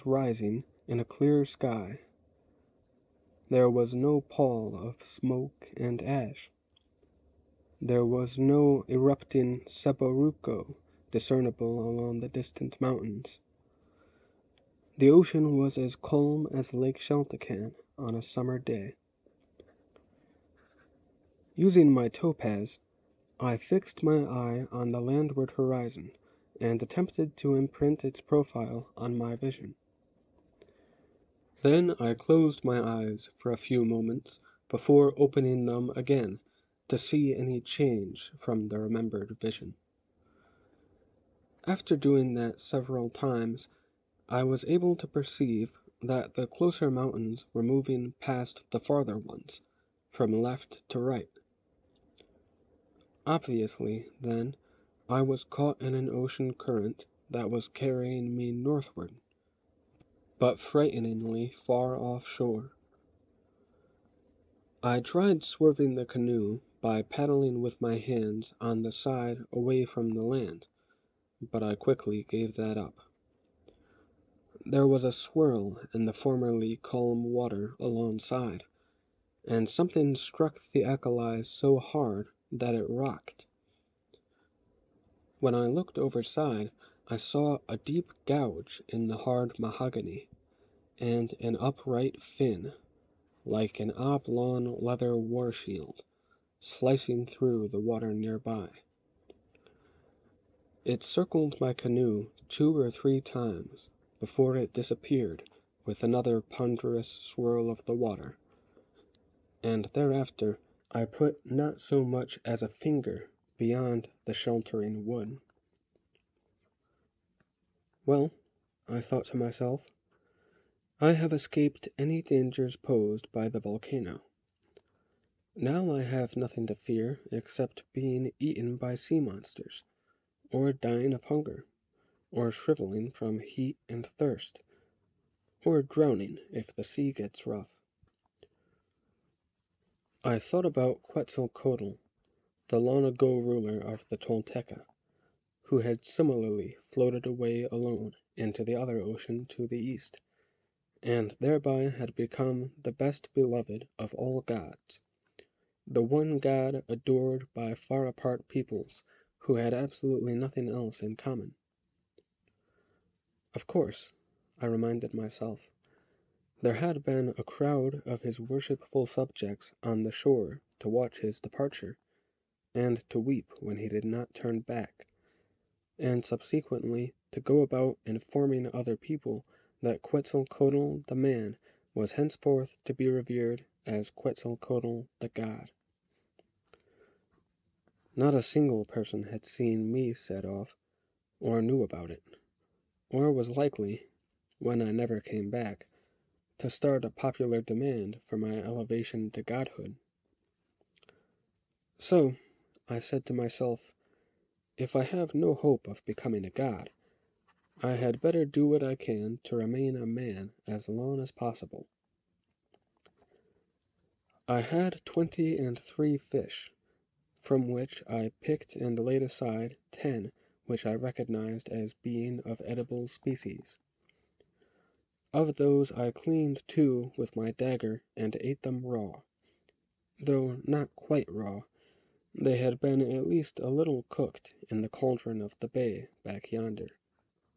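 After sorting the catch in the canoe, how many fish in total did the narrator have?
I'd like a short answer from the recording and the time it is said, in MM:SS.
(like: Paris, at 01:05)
23, at 03:35.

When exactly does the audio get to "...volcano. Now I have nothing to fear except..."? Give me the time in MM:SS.
02:03.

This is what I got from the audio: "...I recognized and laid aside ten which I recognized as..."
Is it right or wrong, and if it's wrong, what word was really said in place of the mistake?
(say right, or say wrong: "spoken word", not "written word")
wrong: "picked", not "recognized".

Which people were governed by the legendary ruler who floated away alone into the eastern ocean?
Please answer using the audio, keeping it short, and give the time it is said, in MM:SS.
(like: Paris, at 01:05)
The Tolteca, at 02:24.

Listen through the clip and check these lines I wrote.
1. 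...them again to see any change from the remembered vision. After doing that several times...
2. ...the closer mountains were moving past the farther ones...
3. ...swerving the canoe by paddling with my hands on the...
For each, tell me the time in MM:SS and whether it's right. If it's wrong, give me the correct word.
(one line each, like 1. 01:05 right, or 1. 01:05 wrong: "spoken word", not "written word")
1. 00:35 right
2. 00:46 right
3. 01:05 right.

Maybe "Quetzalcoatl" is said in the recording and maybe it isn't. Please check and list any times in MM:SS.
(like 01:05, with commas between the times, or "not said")
02:21, 03:00, 03:04.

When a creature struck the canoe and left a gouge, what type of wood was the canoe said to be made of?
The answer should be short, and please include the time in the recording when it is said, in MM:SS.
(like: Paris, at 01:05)
Mahogany, at 01:29.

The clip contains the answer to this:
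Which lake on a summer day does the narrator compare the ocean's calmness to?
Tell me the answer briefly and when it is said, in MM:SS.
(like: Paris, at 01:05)
Lake Chantecan, at 00:16.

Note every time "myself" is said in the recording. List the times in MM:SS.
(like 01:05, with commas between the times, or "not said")
01:59, 02:45, 03:23.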